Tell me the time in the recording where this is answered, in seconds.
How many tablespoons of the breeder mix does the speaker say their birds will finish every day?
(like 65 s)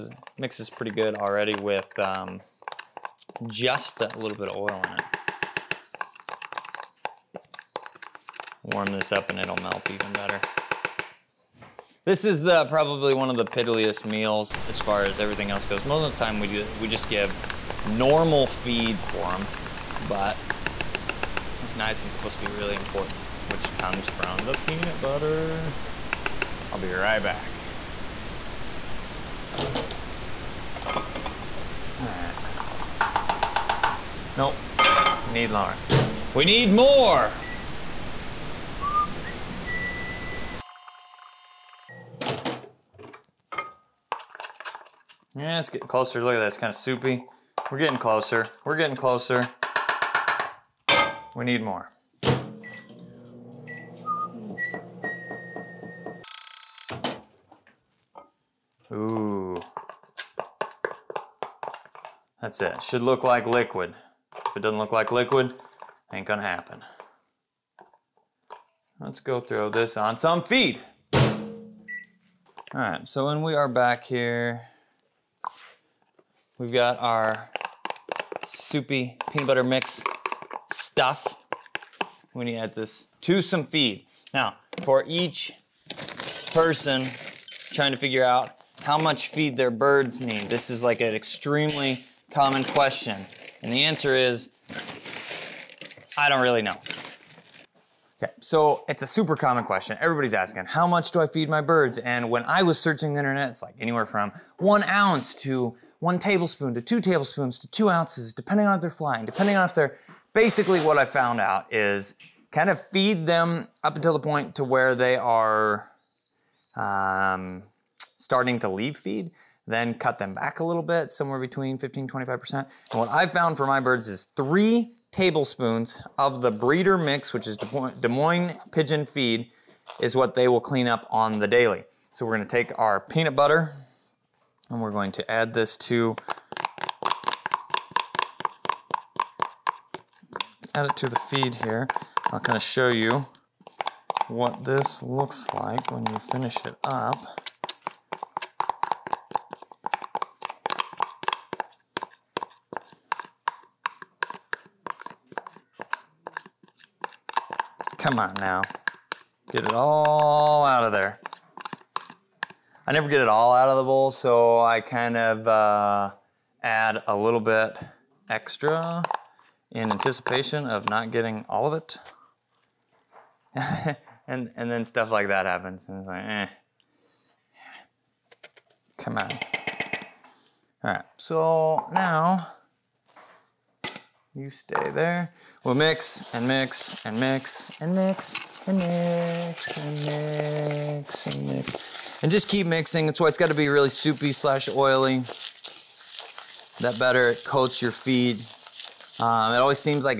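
124 s.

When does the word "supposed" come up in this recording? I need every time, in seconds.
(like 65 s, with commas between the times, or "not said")
22 s.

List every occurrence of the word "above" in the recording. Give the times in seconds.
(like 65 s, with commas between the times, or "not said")
not said.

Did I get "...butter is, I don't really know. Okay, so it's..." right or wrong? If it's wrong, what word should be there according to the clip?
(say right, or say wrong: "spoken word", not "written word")
wrong: "answer", not "butter".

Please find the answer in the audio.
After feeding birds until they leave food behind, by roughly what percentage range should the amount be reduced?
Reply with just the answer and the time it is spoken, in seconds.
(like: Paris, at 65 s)
15-25%, at 121 s.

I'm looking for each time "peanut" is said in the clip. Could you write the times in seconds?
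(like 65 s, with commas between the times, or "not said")
24 s, 79 s, 133 s.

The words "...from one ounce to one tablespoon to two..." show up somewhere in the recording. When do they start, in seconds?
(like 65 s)
104 s.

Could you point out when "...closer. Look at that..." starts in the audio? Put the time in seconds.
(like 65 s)
45 s.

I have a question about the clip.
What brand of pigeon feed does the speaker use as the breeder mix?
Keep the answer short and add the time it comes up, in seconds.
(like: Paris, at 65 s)
Des Moines, at 127 s.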